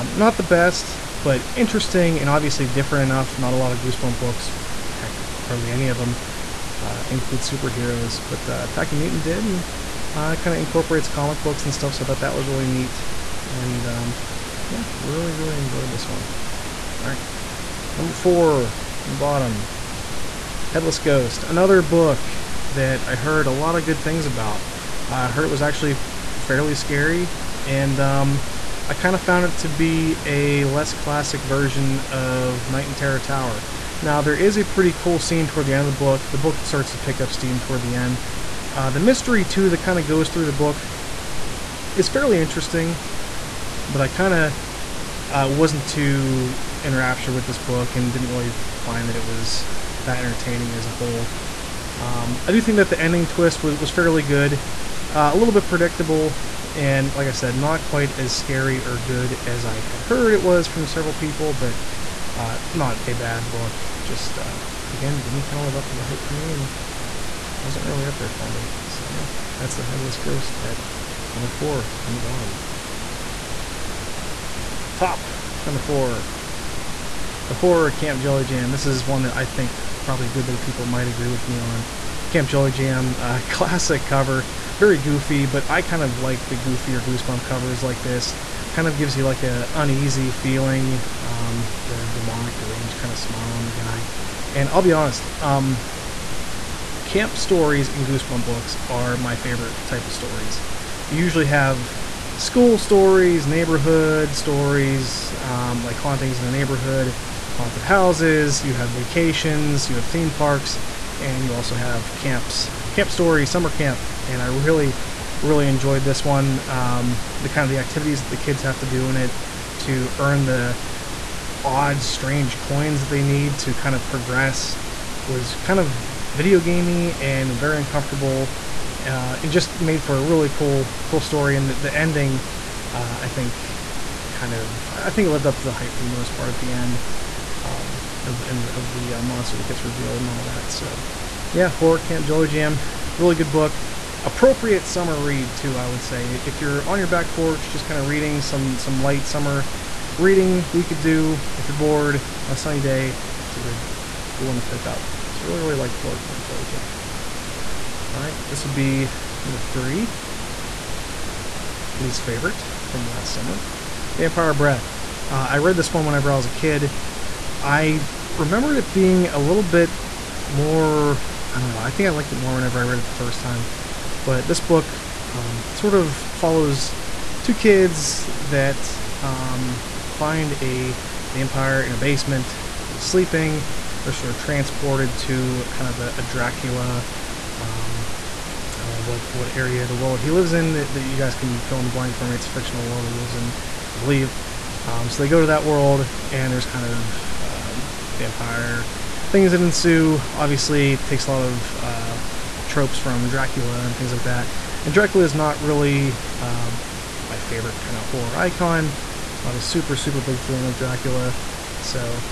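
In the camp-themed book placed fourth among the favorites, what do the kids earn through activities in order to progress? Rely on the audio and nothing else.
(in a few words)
Coins.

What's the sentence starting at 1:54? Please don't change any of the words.
And I really, really enjoyed this one.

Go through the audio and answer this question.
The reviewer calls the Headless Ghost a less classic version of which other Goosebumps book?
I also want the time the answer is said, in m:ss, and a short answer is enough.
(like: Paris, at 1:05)
Night in Terror Tower, at 0:32.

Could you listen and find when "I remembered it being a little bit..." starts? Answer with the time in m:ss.
2:47.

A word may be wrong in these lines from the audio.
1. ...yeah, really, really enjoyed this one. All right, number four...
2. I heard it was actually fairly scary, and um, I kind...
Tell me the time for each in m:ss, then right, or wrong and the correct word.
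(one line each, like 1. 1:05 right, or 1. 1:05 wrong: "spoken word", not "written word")
1. 0:14 right
2. 0:25 right.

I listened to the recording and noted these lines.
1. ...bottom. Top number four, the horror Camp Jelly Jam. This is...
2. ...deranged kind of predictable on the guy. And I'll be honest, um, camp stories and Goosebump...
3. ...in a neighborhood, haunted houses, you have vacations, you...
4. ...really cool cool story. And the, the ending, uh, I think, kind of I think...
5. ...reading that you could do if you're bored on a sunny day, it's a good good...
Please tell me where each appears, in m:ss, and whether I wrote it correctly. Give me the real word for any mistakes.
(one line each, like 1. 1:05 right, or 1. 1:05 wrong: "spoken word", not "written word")
1. 1:12 right
2. 1:32 wrong: "smile", not "predictable"
3. 1:46 right
4. 2:10 right
5. 2:30 right.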